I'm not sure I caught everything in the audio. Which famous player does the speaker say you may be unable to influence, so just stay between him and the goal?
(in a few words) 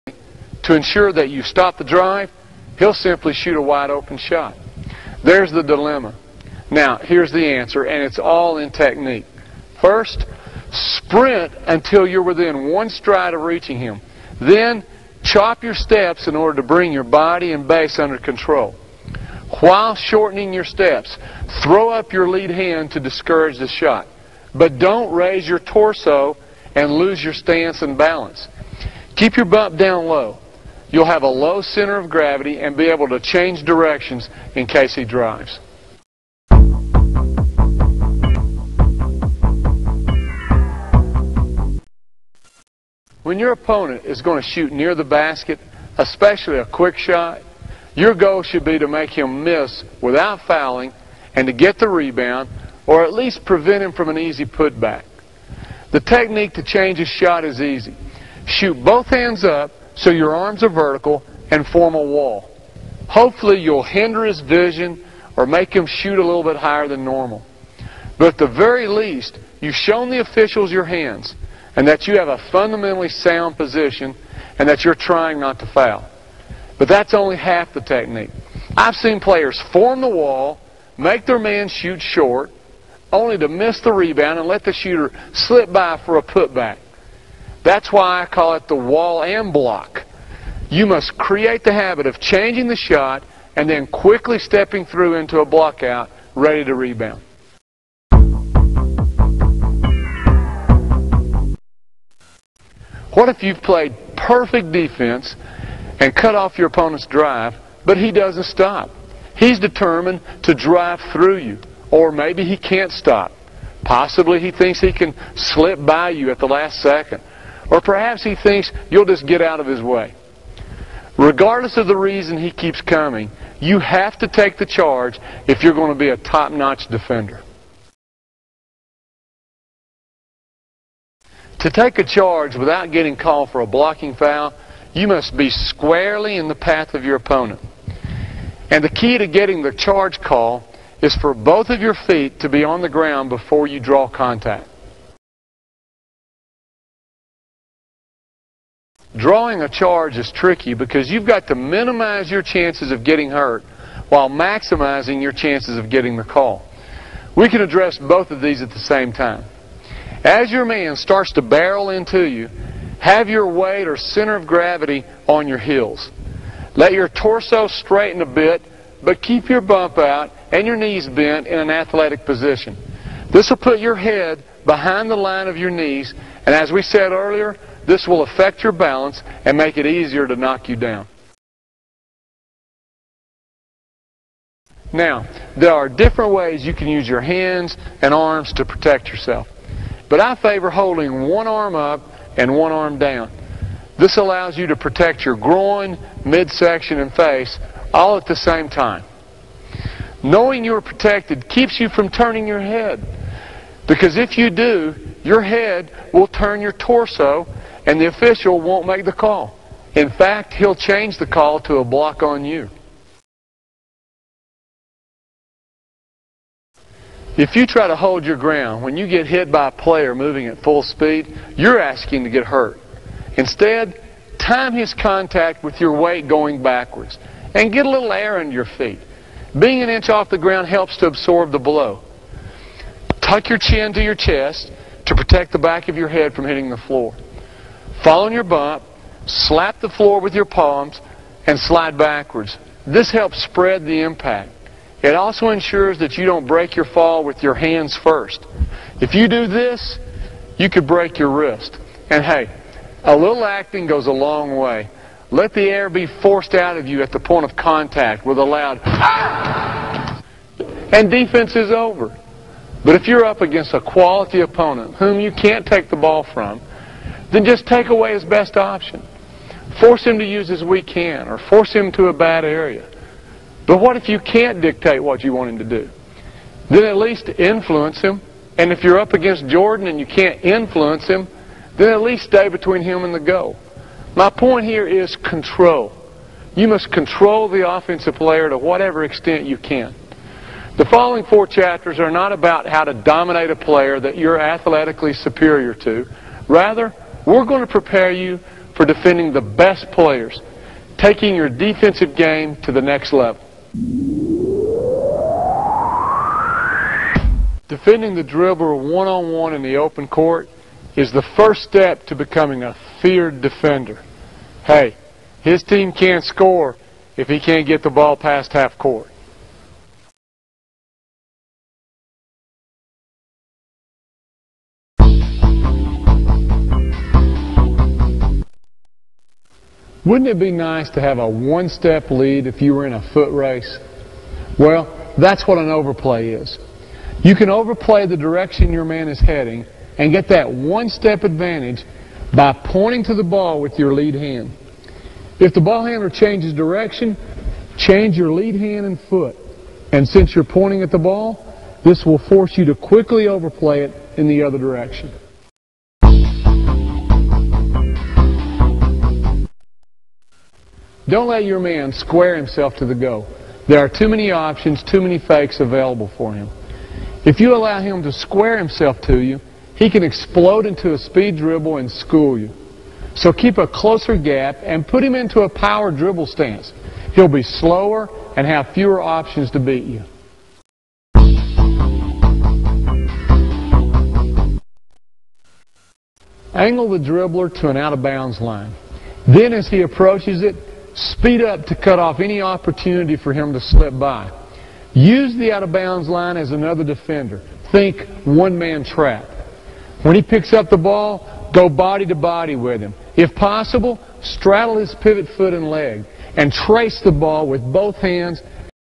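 Jordan.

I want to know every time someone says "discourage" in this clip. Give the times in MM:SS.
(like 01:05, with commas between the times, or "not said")
00:22.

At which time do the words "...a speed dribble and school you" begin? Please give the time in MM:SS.
06:10.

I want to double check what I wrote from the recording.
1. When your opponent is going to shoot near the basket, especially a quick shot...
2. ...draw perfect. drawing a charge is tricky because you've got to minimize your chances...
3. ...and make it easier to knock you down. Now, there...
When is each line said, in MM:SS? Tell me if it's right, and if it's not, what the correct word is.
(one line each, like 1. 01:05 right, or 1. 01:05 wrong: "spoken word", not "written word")
1. 00:43 right
2. 02:23 wrong: "contact", not "perfect"
3. 02:59 right.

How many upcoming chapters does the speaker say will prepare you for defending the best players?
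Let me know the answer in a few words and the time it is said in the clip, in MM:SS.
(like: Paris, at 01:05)
4, at 04:51.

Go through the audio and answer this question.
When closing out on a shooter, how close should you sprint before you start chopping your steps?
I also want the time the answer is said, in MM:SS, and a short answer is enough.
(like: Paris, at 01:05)
Within one stride, at 00:12.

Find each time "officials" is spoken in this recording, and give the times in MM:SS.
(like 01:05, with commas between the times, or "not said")
01:10, 03:28.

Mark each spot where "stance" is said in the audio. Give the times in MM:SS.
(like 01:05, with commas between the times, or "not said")
00:27, 06:16.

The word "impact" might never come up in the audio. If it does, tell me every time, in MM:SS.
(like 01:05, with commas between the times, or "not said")
04:04.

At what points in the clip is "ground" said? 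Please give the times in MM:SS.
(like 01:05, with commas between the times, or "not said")
02:22, 03:38, 03:50.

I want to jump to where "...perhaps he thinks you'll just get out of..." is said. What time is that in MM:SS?
01:57.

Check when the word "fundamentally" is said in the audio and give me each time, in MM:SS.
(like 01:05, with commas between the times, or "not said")
01:12.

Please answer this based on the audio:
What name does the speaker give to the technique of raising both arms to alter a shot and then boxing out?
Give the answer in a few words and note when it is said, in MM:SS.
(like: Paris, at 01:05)
The wall and block, at 01:28.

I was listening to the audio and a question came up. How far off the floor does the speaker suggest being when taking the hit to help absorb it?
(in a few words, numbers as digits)
An inch.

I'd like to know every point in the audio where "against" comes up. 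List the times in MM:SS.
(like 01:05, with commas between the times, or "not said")
04:23, 04:39.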